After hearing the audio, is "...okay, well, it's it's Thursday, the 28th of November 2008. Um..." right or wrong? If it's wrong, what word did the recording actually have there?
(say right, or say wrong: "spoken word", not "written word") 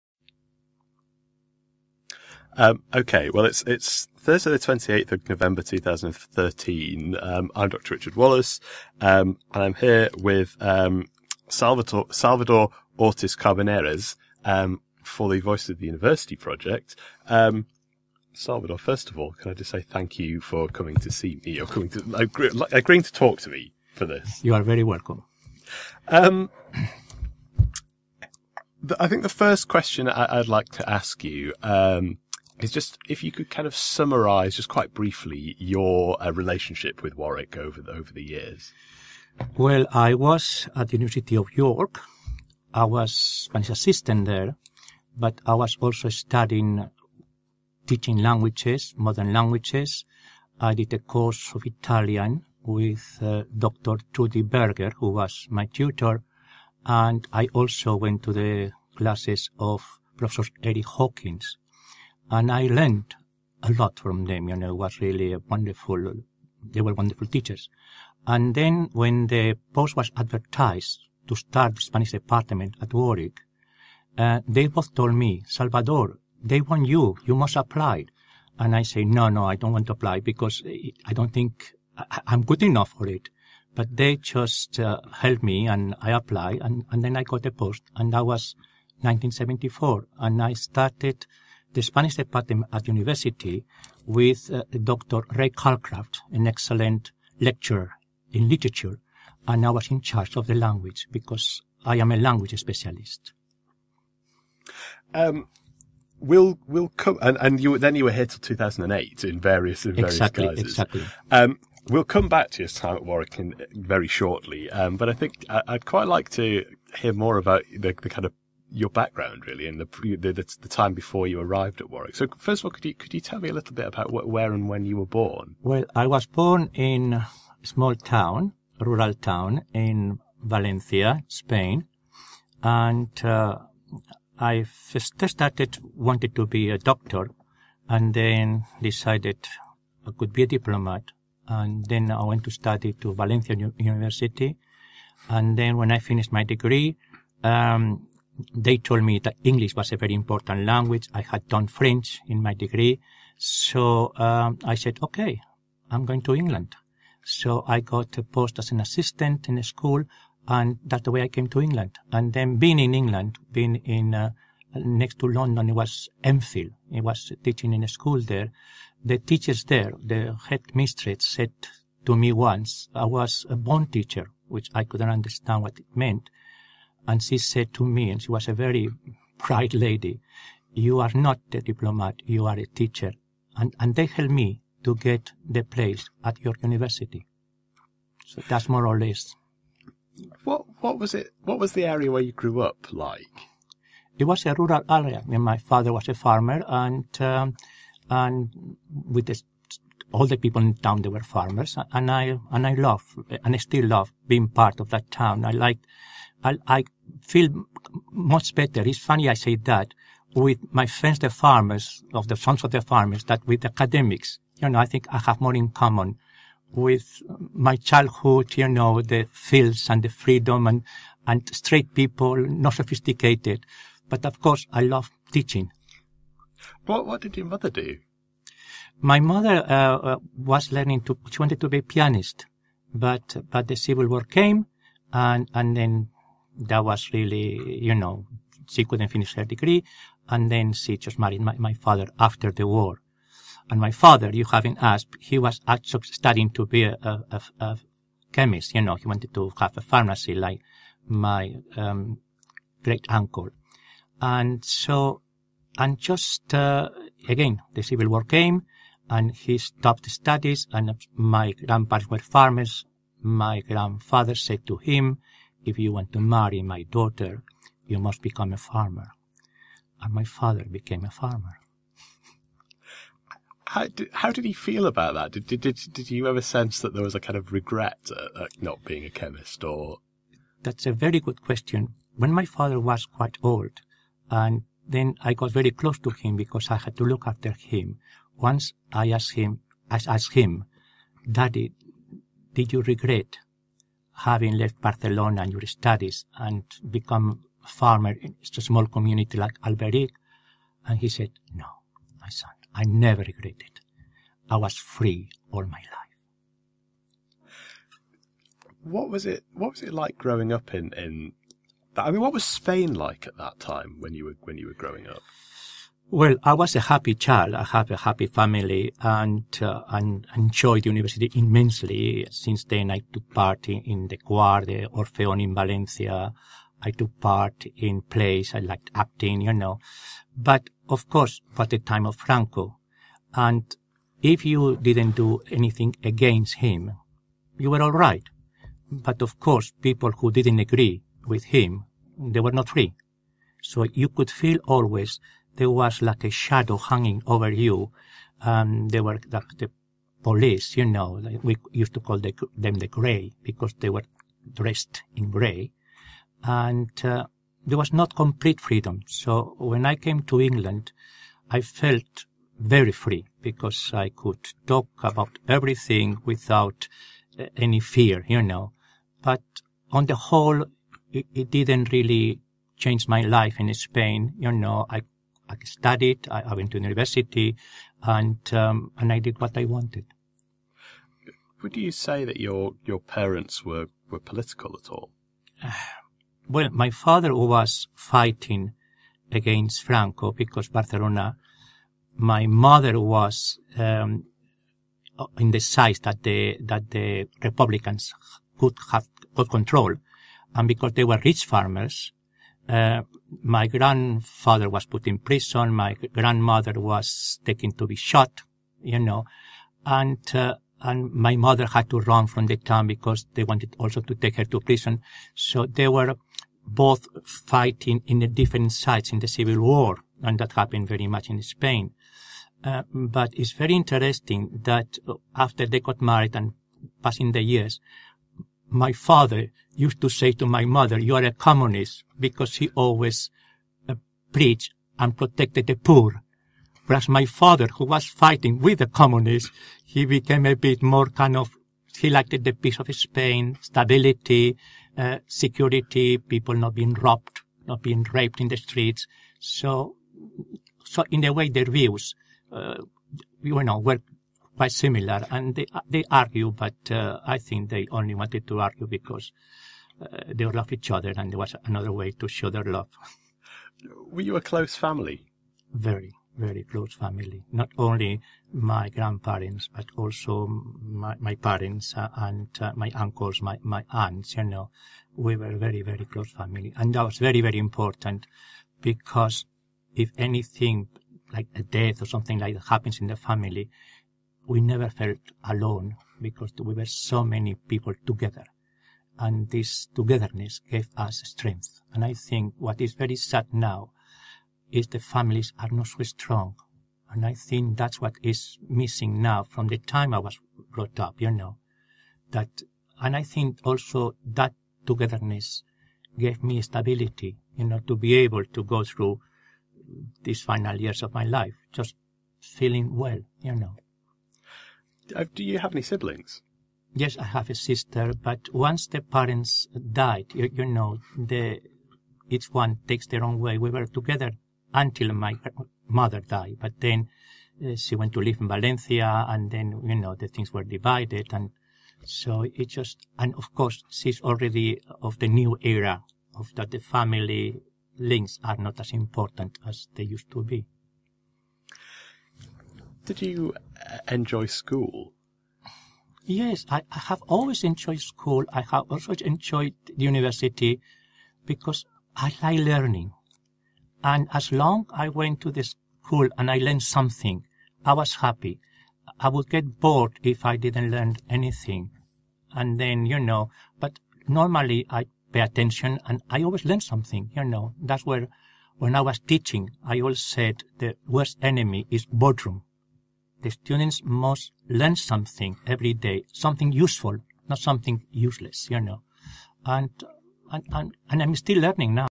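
wrong: "2013", not "2008".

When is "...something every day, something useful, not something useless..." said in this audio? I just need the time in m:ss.
9:34.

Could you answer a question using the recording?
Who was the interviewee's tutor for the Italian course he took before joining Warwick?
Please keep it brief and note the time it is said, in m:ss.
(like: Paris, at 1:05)
Dr. Trudy Berger, at 0:53.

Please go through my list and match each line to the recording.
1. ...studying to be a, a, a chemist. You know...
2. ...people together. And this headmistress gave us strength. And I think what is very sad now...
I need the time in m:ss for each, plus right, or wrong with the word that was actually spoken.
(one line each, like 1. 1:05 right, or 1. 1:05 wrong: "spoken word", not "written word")
1. 4:06 right
2. 8:07 wrong: "togetherness", not "headmistress".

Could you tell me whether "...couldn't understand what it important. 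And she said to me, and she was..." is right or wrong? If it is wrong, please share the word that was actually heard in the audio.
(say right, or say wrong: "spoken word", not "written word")
wrong: "meant", not "important".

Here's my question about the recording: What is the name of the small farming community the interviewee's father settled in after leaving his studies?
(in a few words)
Alberic.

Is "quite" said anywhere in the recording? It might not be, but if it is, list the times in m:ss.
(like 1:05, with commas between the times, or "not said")
0:34, 1:55, 4:43, 7:34.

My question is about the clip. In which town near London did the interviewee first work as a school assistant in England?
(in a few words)
Enfield.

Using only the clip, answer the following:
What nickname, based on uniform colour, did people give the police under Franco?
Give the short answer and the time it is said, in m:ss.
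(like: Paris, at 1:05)
the gray, at 5:52.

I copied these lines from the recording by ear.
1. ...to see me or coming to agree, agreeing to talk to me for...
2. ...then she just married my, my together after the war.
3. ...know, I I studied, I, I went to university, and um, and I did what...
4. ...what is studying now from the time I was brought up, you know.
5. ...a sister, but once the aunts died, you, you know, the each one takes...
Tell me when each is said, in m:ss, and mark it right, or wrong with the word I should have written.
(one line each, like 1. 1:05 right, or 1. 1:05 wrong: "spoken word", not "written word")
1. 0:20 right
2. 4:00 wrong: "father", not "together"
3. 6:14 right
4. 8:17 wrong: "missing", not "studying"
5. 8:37 wrong: "parents", not "aunts".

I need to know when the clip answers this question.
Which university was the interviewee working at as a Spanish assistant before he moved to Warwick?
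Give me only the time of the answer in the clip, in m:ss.
0:40.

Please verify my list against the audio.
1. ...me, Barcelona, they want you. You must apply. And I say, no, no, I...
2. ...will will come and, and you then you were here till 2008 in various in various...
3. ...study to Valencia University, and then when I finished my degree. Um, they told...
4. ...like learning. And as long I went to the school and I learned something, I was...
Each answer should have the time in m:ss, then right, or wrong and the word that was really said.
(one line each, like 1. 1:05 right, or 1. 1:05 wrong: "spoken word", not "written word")
1. 1:15 wrong: "Salvador", not "Barcelona"
2. 1:46 right
3. 2:22 right
4. 9:12 right.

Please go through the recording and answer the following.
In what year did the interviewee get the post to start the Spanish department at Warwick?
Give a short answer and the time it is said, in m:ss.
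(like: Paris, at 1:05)
1974, at 1:29.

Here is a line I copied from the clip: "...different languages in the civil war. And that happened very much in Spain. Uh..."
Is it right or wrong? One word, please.
wrong.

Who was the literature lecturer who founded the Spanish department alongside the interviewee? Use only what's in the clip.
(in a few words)
Dr. Ray Calcraft.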